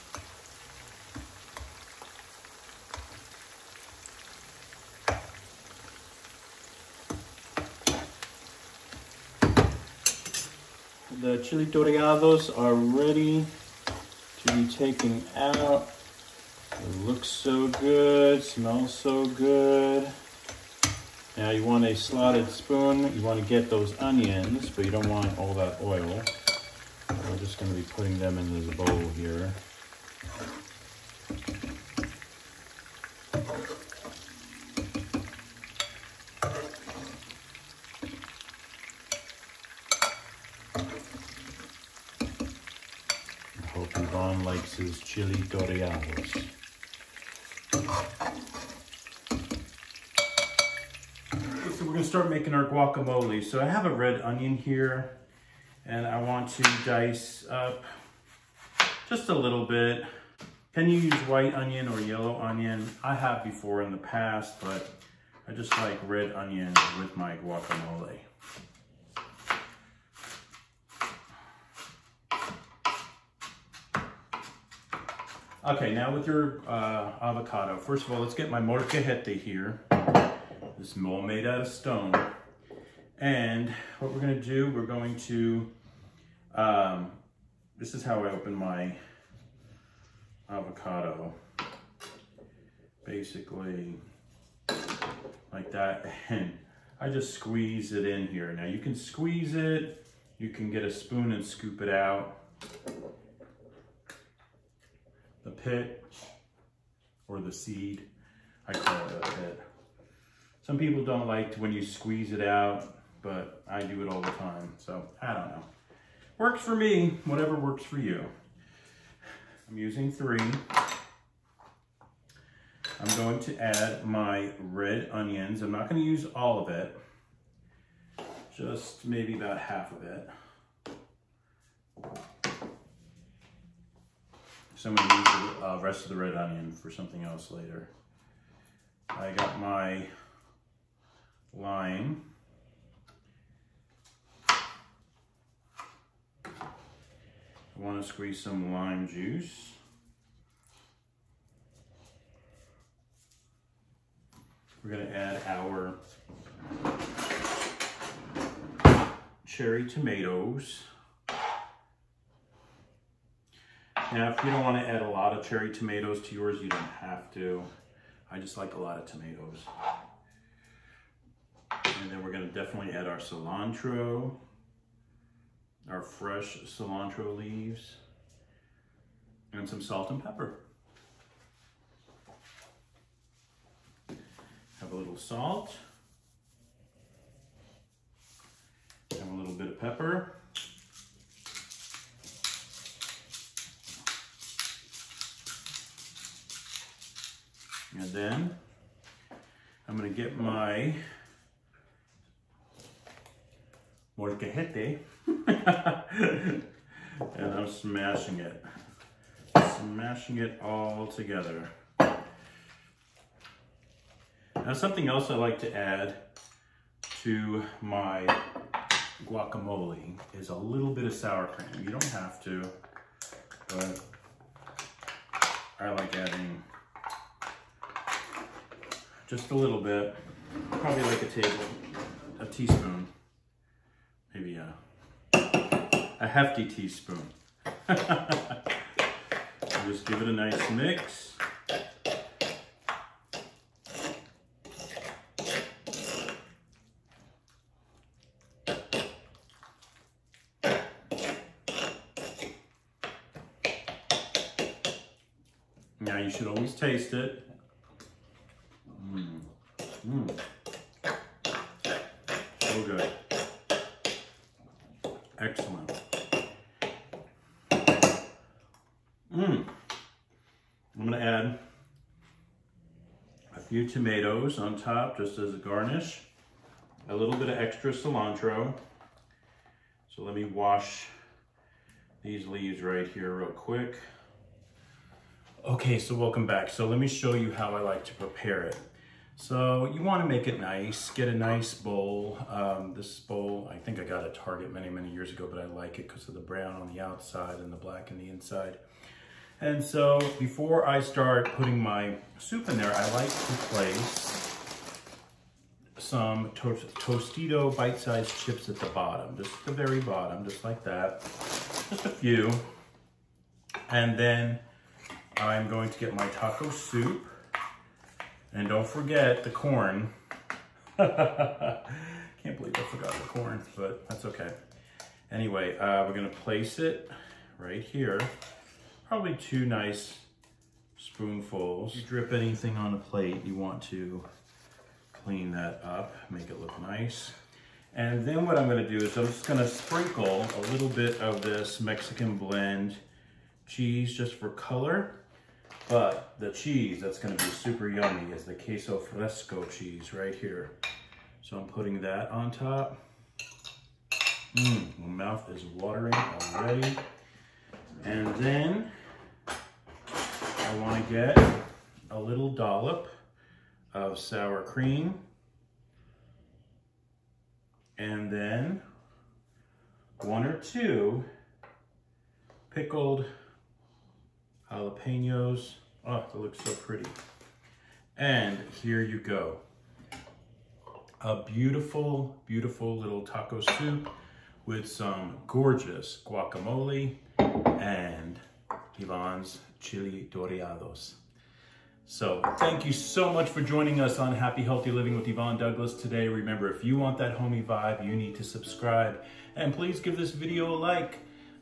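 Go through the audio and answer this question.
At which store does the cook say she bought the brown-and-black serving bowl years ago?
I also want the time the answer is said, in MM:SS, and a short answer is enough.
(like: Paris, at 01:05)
Target, at 04:54.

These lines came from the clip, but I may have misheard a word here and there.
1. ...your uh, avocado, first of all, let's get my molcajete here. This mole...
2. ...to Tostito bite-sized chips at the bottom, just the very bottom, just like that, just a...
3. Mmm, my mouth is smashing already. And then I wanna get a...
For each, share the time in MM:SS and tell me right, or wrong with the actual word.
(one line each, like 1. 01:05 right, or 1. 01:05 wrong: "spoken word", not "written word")
1. 01:16 right
2. 05:06 right
3. 05:54 wrong: "watering", not "smashing".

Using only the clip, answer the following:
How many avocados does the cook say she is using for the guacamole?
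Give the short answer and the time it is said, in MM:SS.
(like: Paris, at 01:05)
3, at 01:59.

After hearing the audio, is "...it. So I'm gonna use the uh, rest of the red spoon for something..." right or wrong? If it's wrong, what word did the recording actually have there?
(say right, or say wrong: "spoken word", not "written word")
wrong: "onion", not "spoon".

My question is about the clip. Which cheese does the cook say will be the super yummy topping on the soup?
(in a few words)
Queso fresco.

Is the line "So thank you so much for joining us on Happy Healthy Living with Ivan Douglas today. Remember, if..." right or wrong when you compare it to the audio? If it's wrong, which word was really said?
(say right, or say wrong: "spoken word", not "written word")
right.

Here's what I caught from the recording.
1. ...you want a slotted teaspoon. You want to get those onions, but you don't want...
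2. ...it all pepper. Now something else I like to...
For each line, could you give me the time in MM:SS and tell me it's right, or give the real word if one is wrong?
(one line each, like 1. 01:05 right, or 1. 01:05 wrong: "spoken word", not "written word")
1. 00:21 wrong: "spoon", not "teaspoon"
2. 03:30 wrong: "together", not "pepper".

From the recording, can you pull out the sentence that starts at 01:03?
I have before in the past, but I just like red onion with my guacamole.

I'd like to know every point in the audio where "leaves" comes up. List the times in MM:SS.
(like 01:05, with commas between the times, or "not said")
02:57, 04:42.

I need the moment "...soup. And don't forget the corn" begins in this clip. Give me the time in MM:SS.
05:16.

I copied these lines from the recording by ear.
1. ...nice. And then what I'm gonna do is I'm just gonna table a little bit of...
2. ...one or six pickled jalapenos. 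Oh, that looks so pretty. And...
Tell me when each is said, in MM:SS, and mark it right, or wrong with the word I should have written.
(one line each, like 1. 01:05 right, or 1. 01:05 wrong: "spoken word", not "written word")
1. 05:36 wrong: "sprinkle", not "table"
2. 06:10 wrong: "two", not "six".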